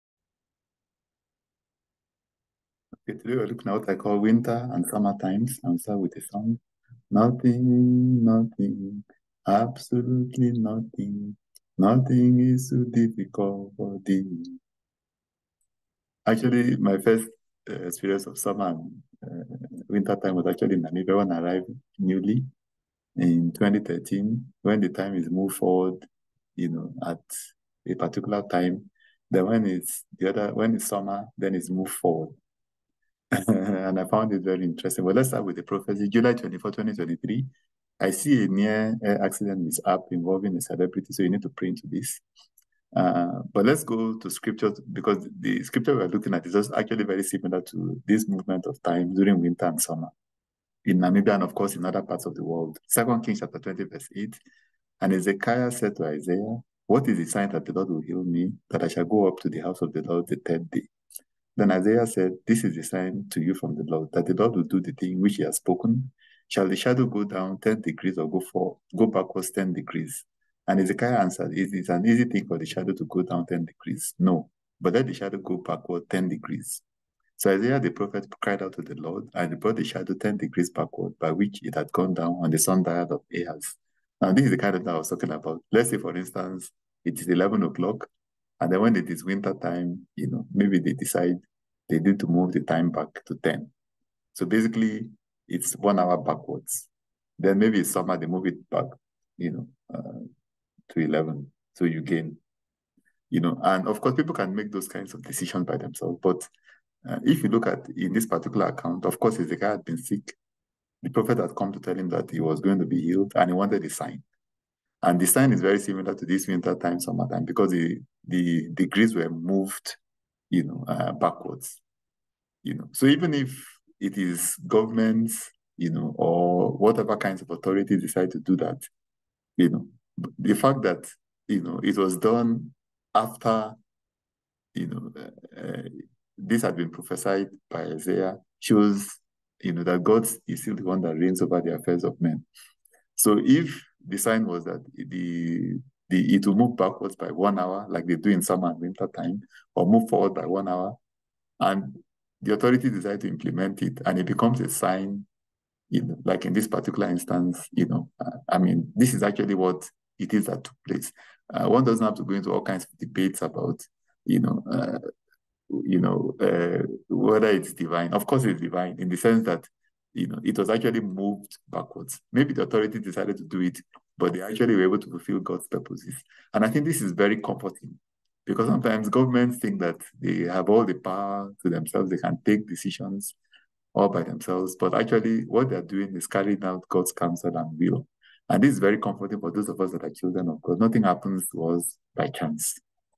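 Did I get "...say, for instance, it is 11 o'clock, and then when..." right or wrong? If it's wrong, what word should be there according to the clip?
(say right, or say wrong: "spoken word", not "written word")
right.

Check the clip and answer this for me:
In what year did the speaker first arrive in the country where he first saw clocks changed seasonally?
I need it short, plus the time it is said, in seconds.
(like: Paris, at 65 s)
2013, at 23 s.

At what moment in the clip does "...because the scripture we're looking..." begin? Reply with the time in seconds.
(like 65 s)
44 s.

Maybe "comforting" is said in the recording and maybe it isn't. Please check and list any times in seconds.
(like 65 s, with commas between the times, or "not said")
177 s, 188 s.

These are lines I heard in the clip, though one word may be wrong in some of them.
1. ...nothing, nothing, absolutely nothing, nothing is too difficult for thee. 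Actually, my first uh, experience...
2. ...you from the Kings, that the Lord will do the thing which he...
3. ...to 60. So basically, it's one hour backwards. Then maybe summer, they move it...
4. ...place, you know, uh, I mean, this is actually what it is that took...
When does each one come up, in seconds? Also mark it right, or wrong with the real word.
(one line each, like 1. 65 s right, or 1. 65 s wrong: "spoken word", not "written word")
1. 7 s right
2. 63 s wrong: "Lord", not "Kings"
3. 93 s wrong: "10", not "60"
4. 157 s wrong: "instance", not "place".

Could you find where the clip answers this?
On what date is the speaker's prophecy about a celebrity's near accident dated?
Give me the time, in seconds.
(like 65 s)
36 s.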